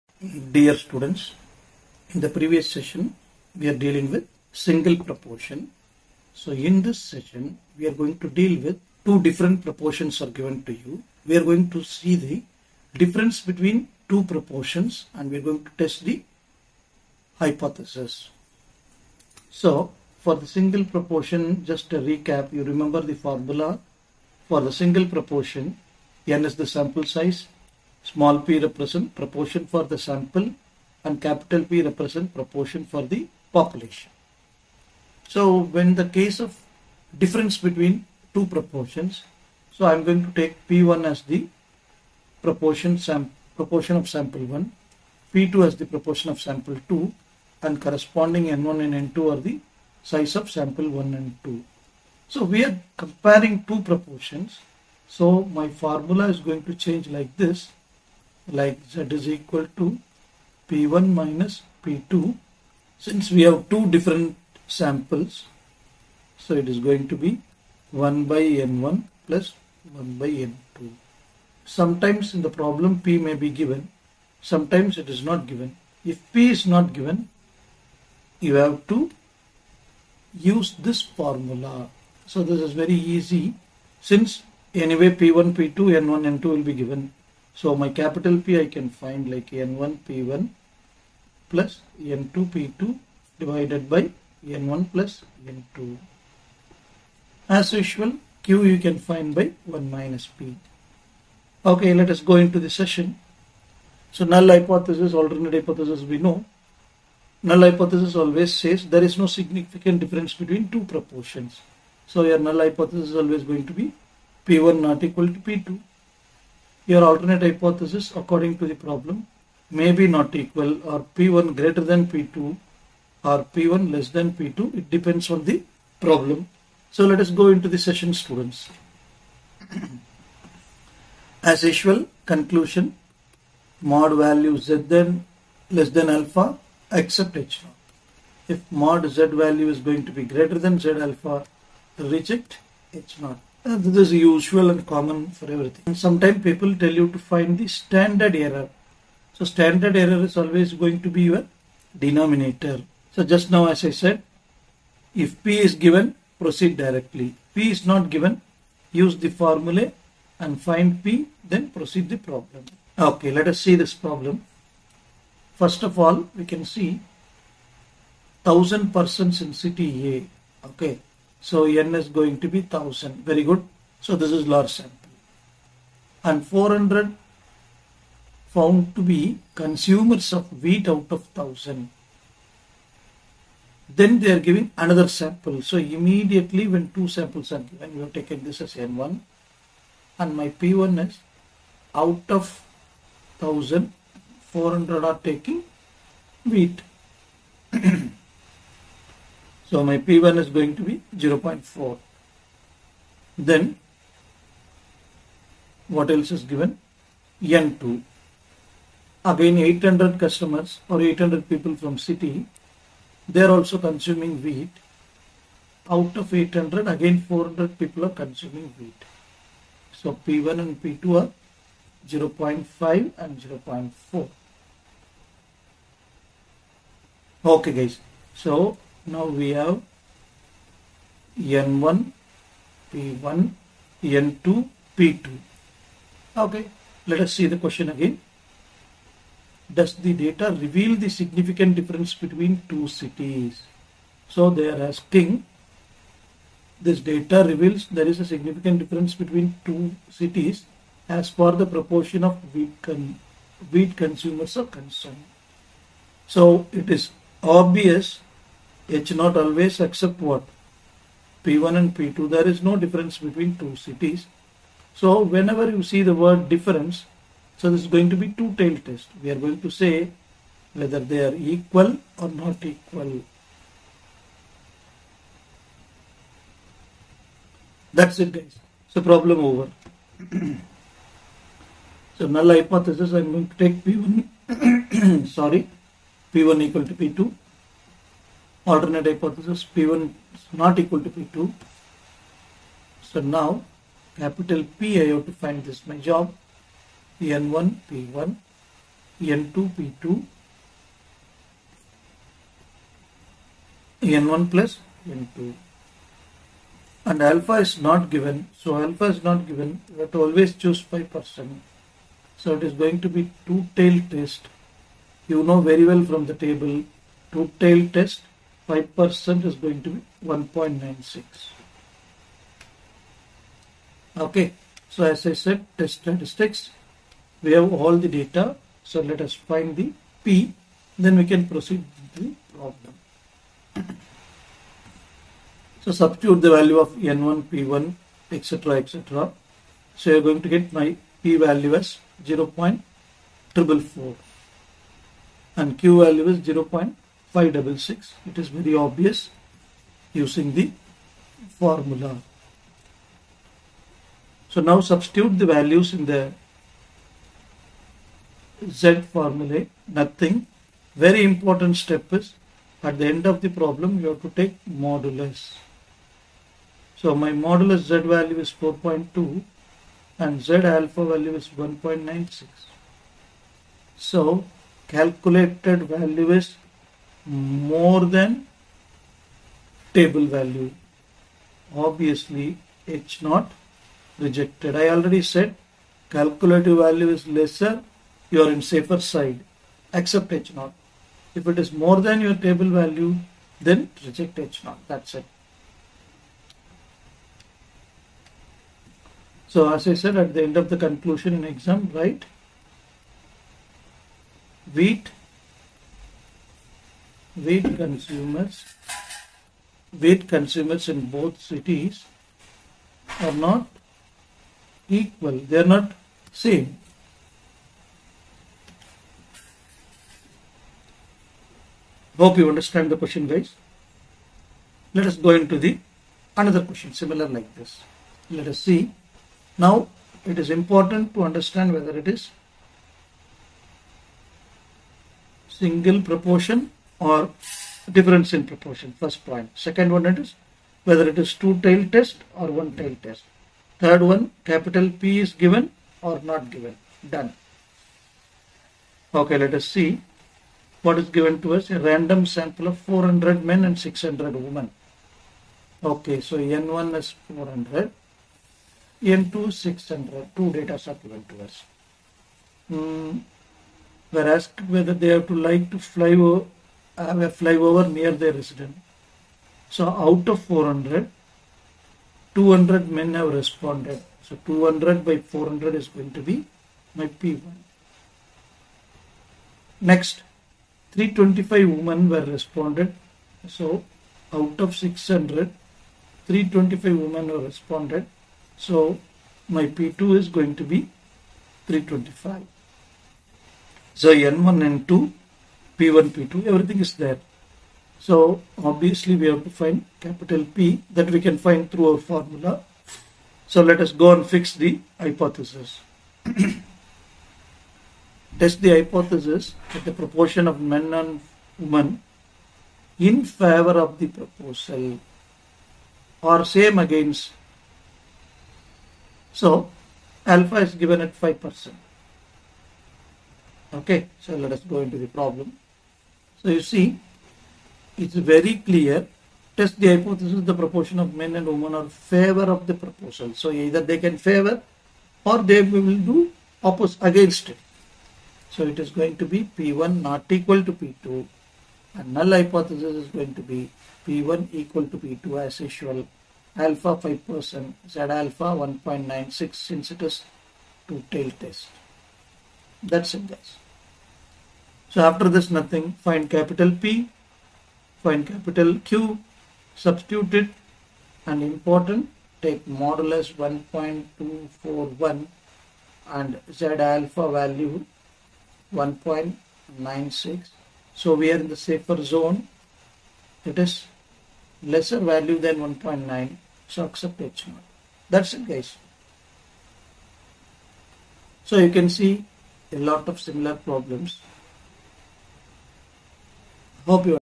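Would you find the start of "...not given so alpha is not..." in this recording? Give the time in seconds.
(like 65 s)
307 s.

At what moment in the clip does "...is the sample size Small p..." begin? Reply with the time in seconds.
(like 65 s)
26 s.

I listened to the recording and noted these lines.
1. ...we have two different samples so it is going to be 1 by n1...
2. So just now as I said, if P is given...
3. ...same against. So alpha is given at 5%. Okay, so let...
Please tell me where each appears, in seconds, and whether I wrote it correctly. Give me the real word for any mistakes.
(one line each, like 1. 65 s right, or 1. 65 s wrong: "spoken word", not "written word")
1. 63 s right
2. 153 s right
3. 516 s right.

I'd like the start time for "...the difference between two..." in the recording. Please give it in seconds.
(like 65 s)
12 s.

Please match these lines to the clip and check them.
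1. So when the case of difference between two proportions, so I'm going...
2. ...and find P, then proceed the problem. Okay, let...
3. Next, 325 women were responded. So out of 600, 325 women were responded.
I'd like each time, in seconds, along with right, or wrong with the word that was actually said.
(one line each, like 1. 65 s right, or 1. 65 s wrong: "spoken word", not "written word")
1. 35 s right
2. 160 s right
3. 479 s right.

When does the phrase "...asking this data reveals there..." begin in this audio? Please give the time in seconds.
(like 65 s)
244 s.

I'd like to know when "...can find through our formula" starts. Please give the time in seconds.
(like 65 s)
501 s.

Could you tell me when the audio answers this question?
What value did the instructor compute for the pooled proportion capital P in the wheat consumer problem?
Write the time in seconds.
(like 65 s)
342 s.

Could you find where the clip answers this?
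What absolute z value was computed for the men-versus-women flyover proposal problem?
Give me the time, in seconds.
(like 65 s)
563 s.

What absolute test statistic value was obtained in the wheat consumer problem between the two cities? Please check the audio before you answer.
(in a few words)
4.2.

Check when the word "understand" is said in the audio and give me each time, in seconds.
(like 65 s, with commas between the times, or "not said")
422 s, 431 s.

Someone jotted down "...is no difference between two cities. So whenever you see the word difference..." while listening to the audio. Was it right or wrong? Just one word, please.
right.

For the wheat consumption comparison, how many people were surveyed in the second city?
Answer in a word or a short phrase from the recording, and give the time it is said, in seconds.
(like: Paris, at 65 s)
800, at 211 s.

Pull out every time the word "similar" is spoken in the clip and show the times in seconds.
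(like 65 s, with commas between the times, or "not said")
426 s, 583 s.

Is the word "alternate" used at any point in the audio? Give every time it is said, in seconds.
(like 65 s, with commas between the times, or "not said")
105 s, 117 s, 288 s.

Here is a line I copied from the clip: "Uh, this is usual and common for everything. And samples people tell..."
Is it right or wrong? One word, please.
wrong.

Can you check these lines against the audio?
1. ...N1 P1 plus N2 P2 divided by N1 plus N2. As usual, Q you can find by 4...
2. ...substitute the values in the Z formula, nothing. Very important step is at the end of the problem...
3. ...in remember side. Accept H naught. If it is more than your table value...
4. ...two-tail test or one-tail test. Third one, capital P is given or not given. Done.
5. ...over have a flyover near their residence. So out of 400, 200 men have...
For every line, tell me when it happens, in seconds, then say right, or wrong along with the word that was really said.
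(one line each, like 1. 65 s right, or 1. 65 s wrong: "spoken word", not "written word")
1. 89 s wrong: "1", not "4"
2. 354 s right
3. 388 s wrong: "safer", not "remember"
4. 441 s right
5. 466 s right.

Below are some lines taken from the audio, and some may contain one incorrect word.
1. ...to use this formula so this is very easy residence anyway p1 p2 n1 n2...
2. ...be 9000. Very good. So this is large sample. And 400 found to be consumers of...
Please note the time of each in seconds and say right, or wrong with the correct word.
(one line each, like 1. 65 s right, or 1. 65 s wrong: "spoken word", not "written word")
1. 78 s wrong: "since", not "residence"
2. 172 s wrong: "1000", not "9000".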